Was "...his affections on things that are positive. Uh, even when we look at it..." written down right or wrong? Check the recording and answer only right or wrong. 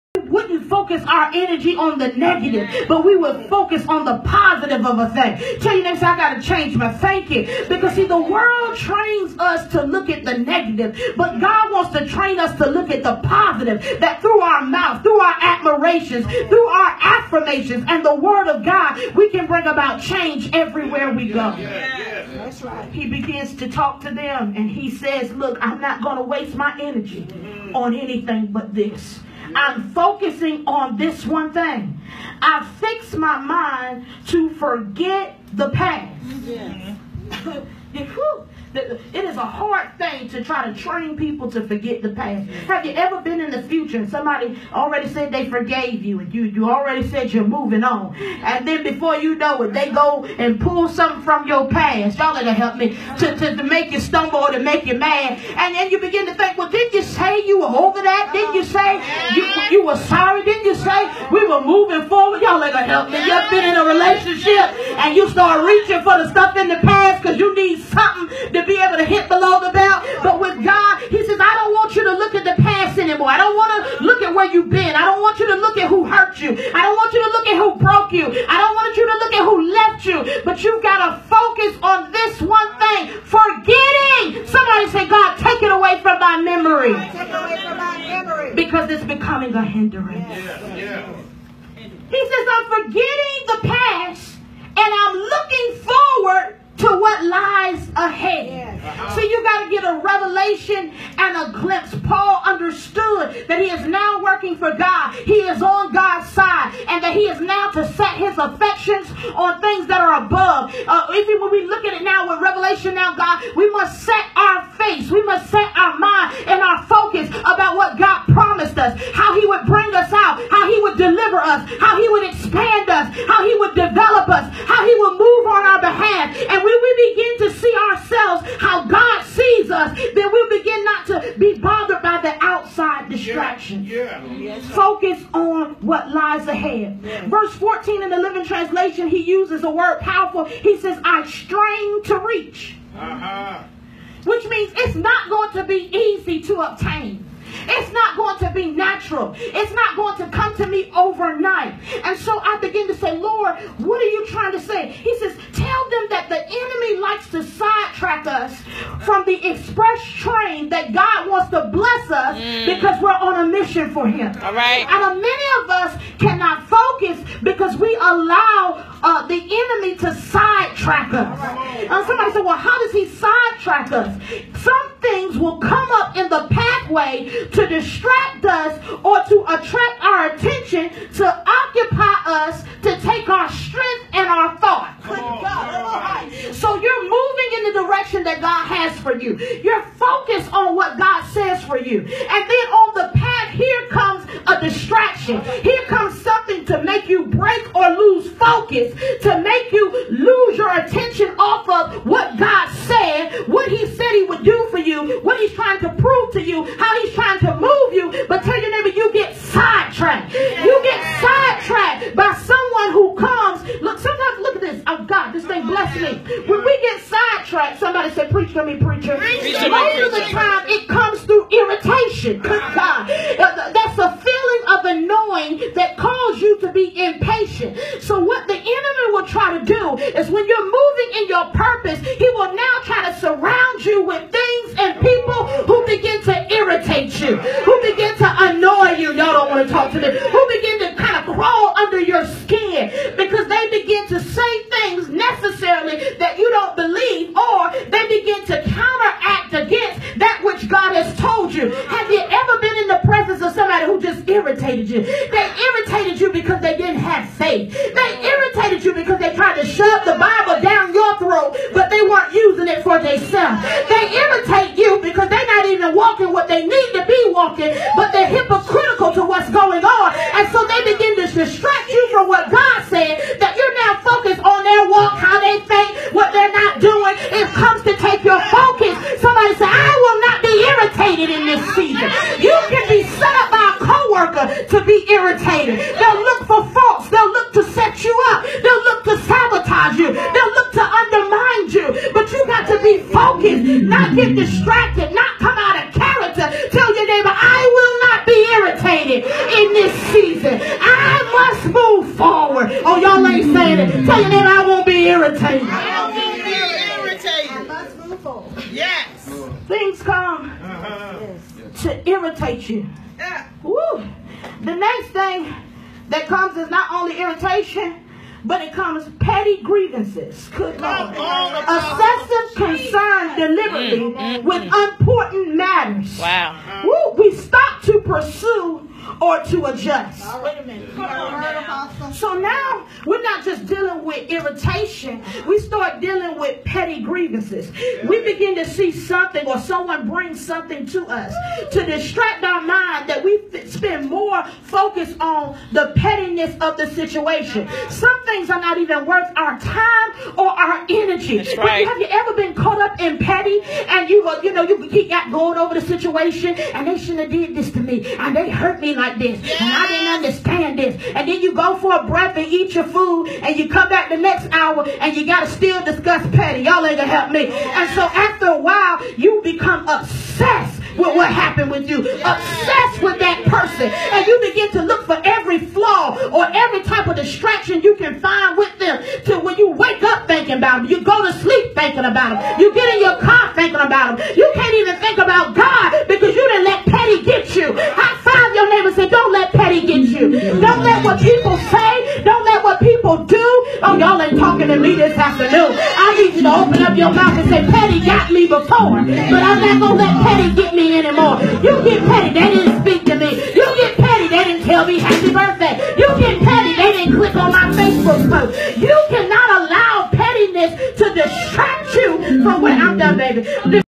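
wrong.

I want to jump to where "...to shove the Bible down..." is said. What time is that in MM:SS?
04:19.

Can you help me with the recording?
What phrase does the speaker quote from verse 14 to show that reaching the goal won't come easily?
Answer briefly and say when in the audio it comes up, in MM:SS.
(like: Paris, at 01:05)
I strain to reach, at 02:21.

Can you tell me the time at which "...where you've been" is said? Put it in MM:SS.
01:14.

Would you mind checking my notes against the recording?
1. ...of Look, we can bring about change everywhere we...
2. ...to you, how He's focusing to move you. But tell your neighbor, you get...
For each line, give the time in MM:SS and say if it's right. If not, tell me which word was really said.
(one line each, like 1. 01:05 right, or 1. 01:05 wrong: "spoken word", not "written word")
1. 00:18 wrong: "God", not "Look"
2. 03:26 wrong: "trying", not "focusing".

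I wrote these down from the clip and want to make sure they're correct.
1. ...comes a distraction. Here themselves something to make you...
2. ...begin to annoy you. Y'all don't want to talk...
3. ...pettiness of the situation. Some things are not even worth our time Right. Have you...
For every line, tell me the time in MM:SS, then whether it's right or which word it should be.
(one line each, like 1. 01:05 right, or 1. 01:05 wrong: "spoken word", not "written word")
1. 03:13 wrong: "comes", not "themselves"
2. 03:57 right
3. 05:45 right.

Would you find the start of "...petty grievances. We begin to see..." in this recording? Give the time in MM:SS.
05:36.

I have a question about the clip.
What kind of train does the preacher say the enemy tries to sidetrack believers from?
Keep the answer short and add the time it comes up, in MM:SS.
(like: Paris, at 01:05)
Express train, at 02:39.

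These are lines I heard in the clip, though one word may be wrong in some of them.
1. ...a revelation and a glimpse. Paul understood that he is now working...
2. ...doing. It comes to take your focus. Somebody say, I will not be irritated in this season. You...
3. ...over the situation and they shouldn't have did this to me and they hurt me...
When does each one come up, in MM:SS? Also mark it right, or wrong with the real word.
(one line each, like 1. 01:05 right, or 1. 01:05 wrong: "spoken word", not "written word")
1. 01:39 right
2. 04:36 right
3. 05:55 right.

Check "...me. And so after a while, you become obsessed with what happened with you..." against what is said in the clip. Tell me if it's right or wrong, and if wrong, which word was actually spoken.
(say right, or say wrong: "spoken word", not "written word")
right.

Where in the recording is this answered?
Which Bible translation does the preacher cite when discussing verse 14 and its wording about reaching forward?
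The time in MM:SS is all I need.
02:18.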